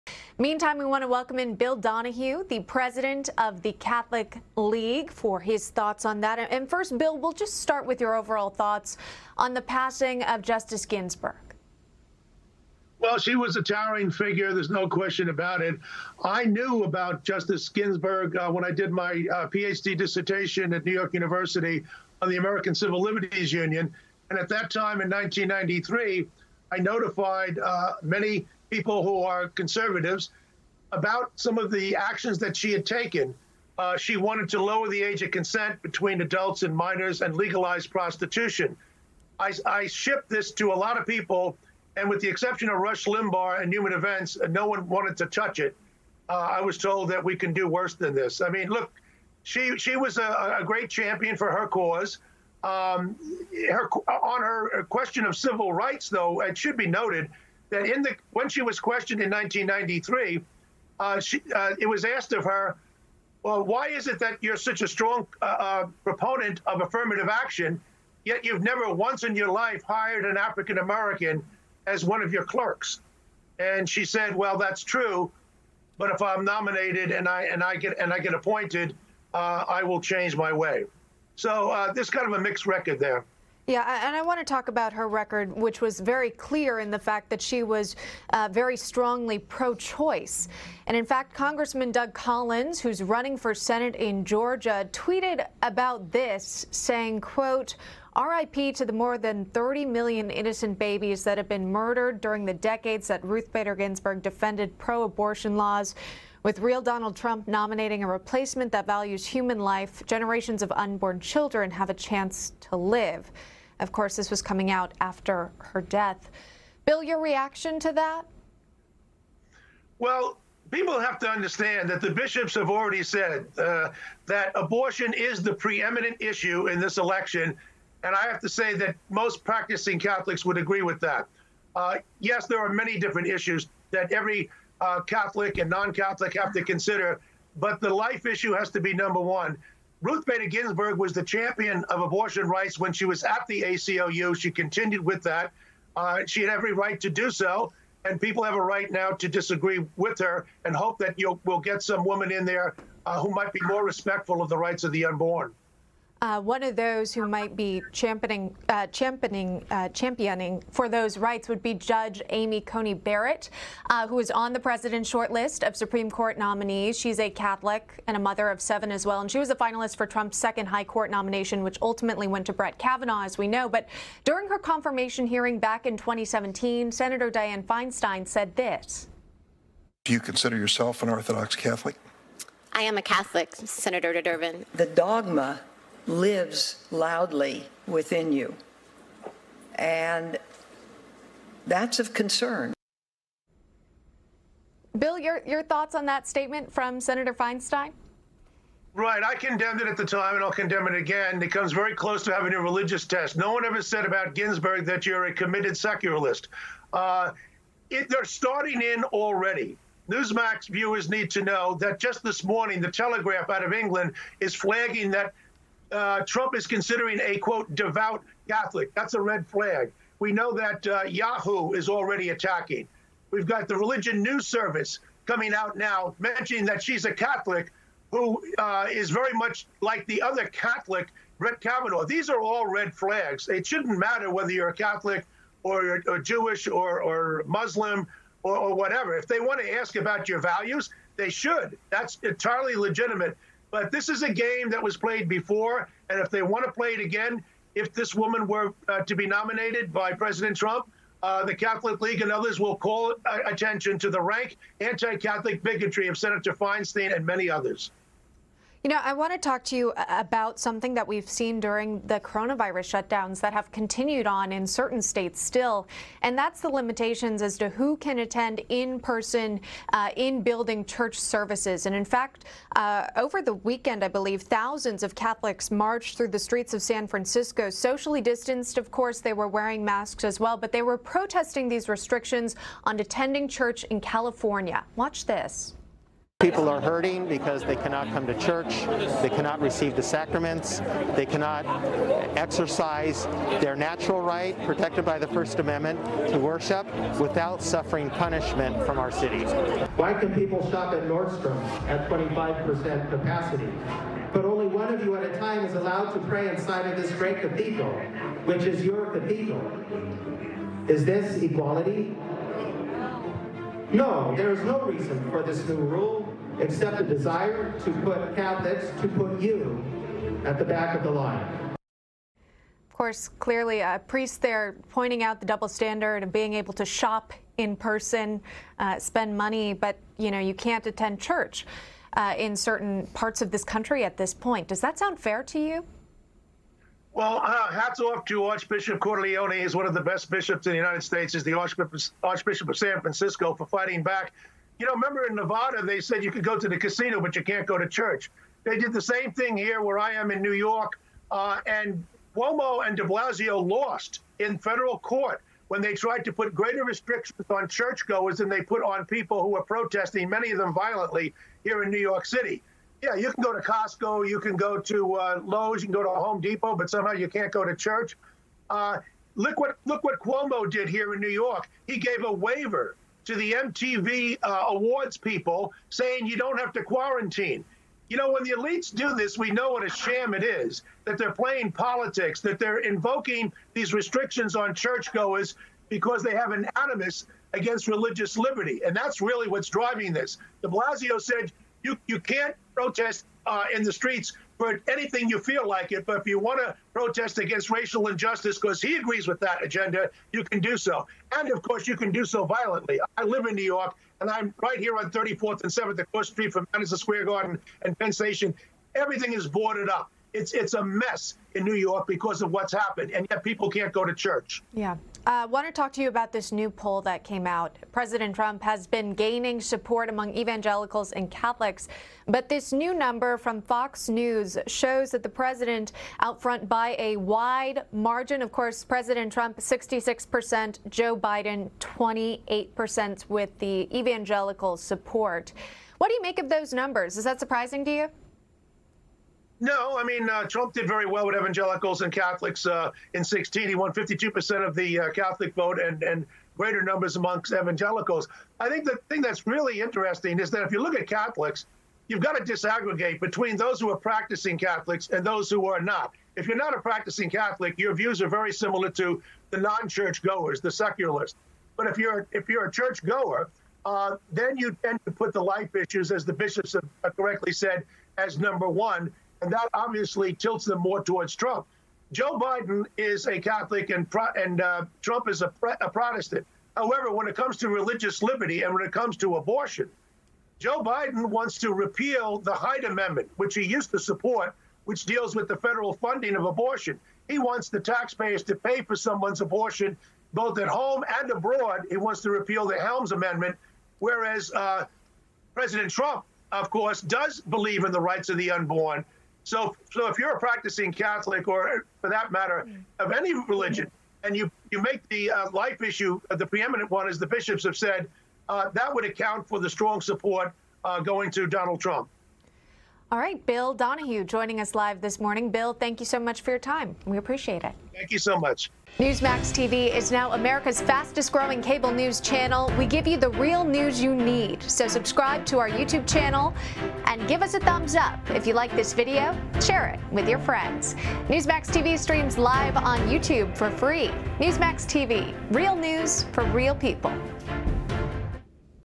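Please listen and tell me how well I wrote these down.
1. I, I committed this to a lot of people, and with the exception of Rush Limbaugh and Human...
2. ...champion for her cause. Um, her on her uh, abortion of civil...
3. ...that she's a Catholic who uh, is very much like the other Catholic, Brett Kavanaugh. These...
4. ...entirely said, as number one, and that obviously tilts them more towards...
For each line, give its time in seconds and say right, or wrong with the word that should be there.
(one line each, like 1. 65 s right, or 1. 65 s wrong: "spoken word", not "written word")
1. 39 s wrong: "shipped", not "committed"
2. 50 s wrong: "question", not "abortion"
3. 226 s right
4. 467 s wrong: "correctly", not "entirely".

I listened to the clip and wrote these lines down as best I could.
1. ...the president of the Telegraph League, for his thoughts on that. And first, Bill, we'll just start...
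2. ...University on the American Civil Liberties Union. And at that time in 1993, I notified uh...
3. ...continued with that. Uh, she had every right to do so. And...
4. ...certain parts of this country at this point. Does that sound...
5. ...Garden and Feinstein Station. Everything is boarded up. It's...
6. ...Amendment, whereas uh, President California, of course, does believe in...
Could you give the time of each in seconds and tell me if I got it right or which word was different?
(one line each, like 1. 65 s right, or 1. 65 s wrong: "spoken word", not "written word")
1. 2 s wrong: "Catholic", not "Telegraph"
2. 21 s right
3. 144 s right
4. 332 s right
5. 407 s wrong: "Penn", not "Feinstein"
6. 493 s wrong: "Trump", not "California".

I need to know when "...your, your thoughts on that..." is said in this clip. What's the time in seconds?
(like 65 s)
195 s.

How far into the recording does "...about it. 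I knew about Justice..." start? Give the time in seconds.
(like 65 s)
15 s.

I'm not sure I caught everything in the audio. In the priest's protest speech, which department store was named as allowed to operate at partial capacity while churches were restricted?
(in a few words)
Nordstrom.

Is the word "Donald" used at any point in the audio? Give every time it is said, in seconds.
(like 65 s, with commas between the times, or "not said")
106 s, 511 s.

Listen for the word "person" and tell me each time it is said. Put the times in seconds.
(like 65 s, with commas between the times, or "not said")
268 s, 327 s.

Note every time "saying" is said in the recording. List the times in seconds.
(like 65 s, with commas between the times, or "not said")
96 s, 375 s.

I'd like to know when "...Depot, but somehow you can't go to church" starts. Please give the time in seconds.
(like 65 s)
366 s.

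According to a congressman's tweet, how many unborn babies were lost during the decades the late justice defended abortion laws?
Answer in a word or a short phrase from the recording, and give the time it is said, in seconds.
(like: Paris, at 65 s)
more than 30 million, at 98 s.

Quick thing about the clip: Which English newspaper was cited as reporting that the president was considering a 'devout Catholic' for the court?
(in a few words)
The Telegraph.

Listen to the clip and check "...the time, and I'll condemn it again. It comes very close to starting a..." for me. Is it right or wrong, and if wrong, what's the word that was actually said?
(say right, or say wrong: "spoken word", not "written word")
wrong: "having", not "starting".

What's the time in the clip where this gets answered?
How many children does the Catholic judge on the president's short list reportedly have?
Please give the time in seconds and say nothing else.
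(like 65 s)
168 s.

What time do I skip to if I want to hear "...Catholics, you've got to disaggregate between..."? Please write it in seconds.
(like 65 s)
451 s.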